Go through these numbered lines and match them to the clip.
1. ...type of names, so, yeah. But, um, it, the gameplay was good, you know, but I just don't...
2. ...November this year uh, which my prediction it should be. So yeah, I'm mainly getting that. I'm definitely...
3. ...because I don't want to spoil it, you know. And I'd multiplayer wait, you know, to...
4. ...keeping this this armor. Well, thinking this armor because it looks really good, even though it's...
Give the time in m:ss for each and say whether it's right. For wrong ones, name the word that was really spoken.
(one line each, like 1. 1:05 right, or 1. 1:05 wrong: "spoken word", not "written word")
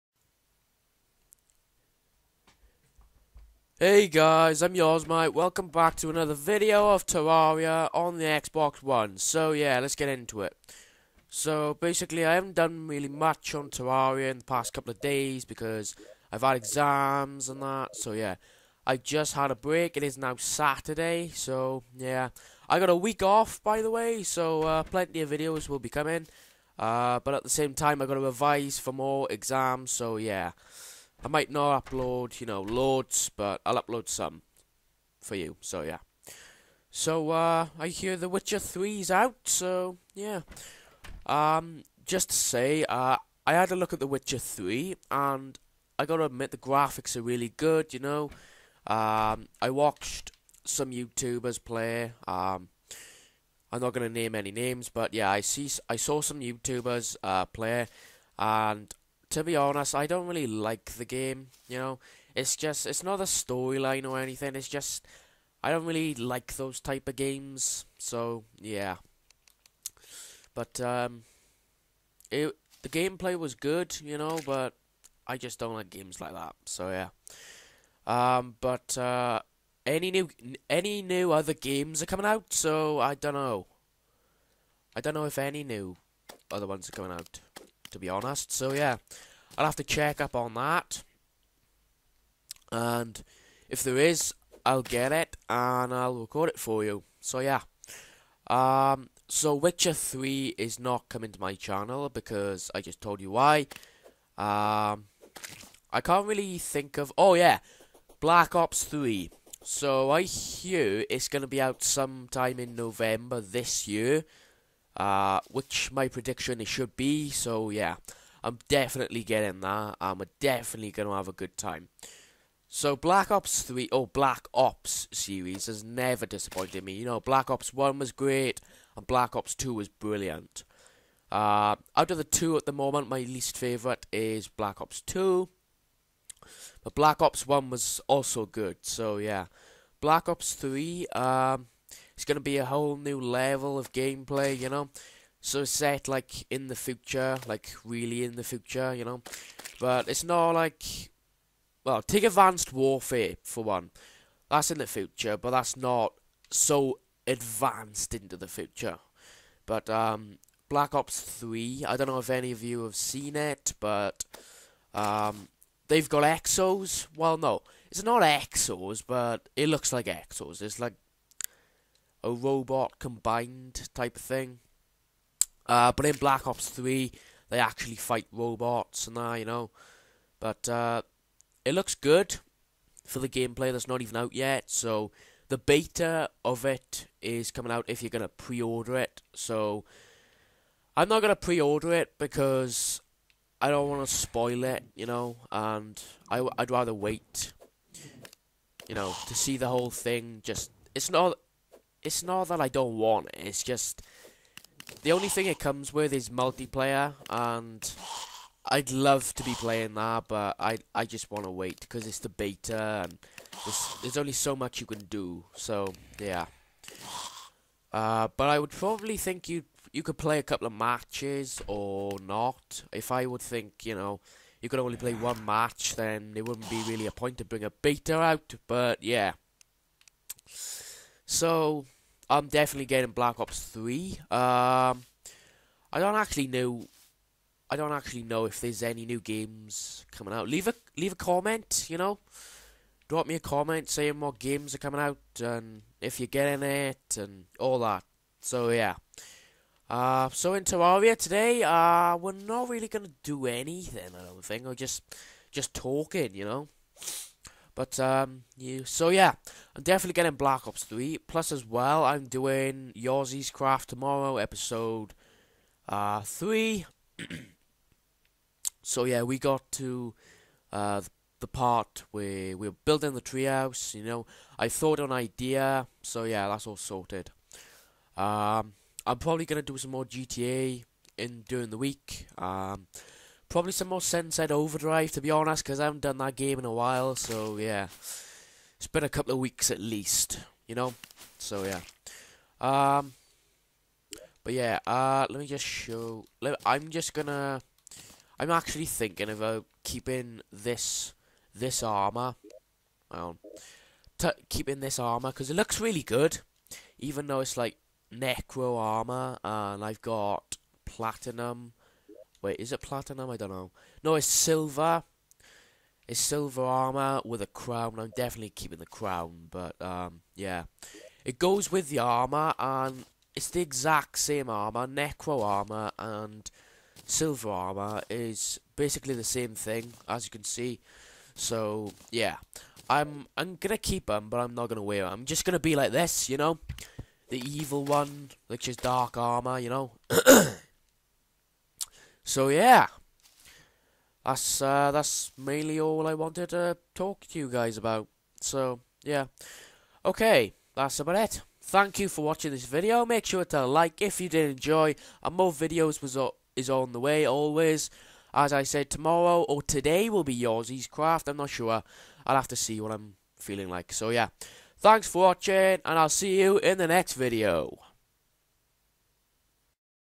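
1. 1:06 wrong: "games", not "names"
2. 1:52 wrong: "definitely", not "mainly"
3. 3:12 wrong: "rather", not "multiplayer"
4. 4:59 wrong: "keeping", not "thinking".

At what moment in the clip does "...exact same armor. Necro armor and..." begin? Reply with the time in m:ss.
5:23.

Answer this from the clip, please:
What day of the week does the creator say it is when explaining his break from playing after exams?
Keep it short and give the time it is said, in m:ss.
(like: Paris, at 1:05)
Saturday, at 0:20.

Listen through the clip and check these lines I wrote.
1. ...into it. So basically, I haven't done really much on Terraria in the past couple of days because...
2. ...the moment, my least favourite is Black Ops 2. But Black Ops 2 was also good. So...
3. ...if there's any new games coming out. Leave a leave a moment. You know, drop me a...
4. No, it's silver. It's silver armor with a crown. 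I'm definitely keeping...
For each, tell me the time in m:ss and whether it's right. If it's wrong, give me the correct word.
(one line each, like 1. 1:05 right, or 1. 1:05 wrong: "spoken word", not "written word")
1. 0:10 right
2. 2:12 wrong: "1", not "2"
3. 3:58 wrong: "comment", not "moment"
4. 5:14 right.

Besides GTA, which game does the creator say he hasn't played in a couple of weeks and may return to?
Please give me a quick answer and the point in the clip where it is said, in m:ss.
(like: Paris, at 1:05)
Overdrive, at 4:44.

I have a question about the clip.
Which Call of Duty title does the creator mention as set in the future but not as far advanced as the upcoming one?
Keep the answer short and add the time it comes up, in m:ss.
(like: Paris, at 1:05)
Advanced Warfare, at 2:32.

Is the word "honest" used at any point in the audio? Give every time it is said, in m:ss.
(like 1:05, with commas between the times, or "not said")
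0:59, 1:28, 4:45.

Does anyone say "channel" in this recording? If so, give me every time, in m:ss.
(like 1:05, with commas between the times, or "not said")
1:41.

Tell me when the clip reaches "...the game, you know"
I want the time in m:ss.
1:00.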